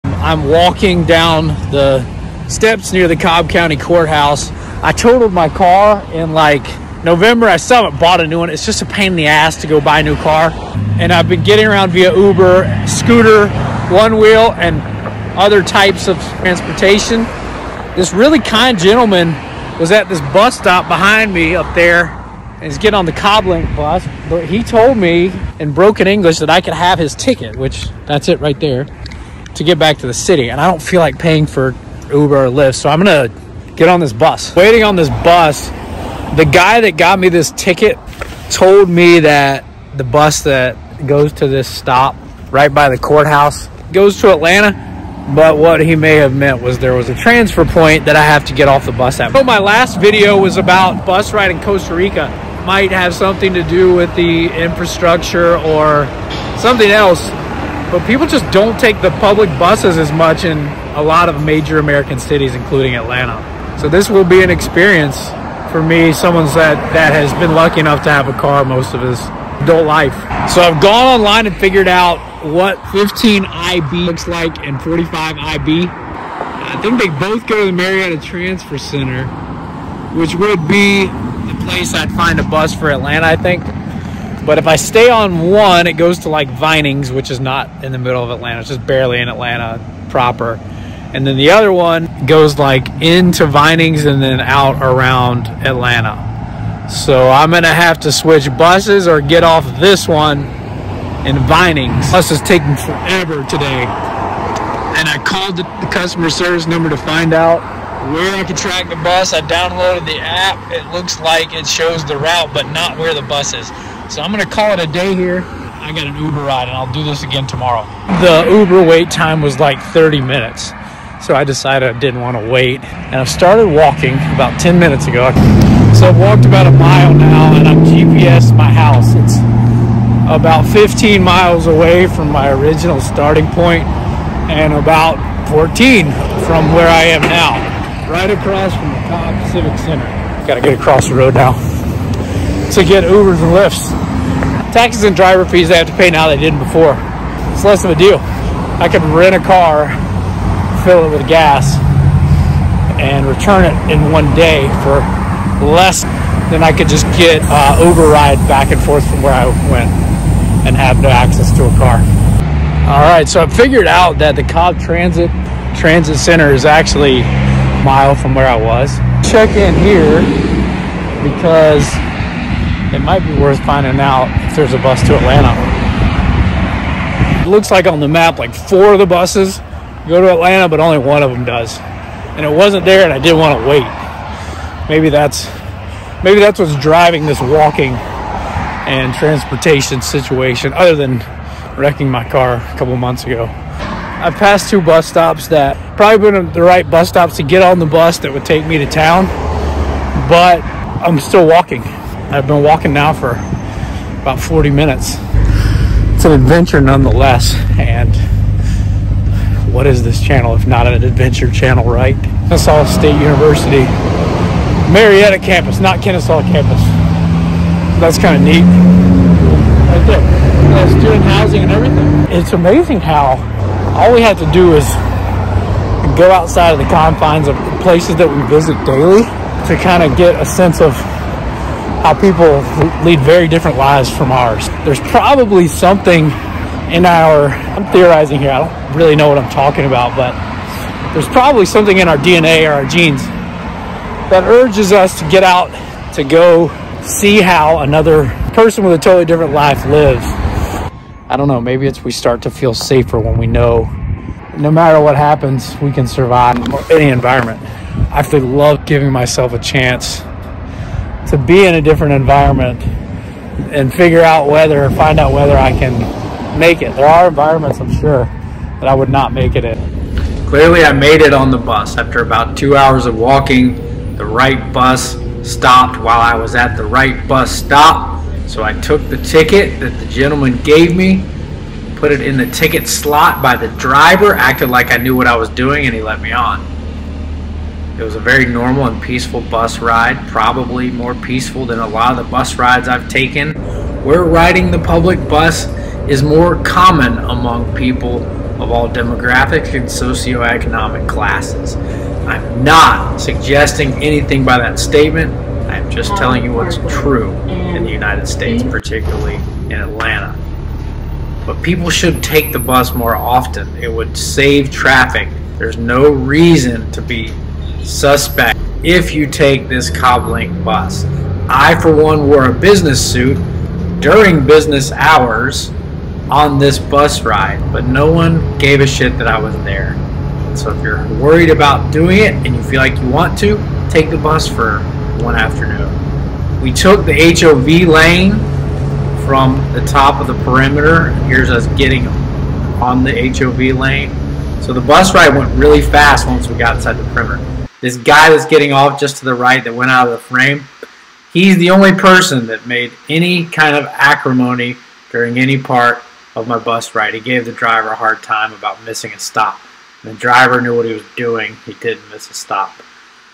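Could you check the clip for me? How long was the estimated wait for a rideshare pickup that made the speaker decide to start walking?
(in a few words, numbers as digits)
30 minutes.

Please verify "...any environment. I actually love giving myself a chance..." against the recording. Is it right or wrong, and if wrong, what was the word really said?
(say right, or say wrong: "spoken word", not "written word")
right.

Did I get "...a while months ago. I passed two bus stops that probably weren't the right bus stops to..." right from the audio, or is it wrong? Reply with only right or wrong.
wrong.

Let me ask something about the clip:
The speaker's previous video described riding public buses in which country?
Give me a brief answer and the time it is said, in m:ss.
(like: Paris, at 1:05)
Costa Rica, at 0:51.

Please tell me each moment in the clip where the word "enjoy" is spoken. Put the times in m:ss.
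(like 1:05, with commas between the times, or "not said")
not said.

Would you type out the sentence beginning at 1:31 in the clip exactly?
And then the other one goes like into Vinings and then out around Atlanta.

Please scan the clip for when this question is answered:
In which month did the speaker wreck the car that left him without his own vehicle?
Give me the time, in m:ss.
0:07.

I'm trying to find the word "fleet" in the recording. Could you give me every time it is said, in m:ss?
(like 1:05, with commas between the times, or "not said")
not said.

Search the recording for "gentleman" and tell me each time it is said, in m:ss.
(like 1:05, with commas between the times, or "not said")
0:18, 4:40.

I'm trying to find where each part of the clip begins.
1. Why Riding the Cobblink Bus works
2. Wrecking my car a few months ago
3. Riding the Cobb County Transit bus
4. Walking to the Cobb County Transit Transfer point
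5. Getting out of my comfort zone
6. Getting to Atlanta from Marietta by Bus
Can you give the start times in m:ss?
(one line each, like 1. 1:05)
1. 5:10
2. 3:12
3. 4:35
4. 1:58
5. 3:45
6. 1:09.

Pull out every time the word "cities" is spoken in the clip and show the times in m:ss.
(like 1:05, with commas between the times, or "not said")
1:02.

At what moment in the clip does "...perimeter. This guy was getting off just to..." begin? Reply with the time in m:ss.
5:47.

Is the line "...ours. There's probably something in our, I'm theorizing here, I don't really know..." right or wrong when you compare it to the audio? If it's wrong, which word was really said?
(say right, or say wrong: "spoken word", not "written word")
right.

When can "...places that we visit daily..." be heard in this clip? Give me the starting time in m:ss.
3:47.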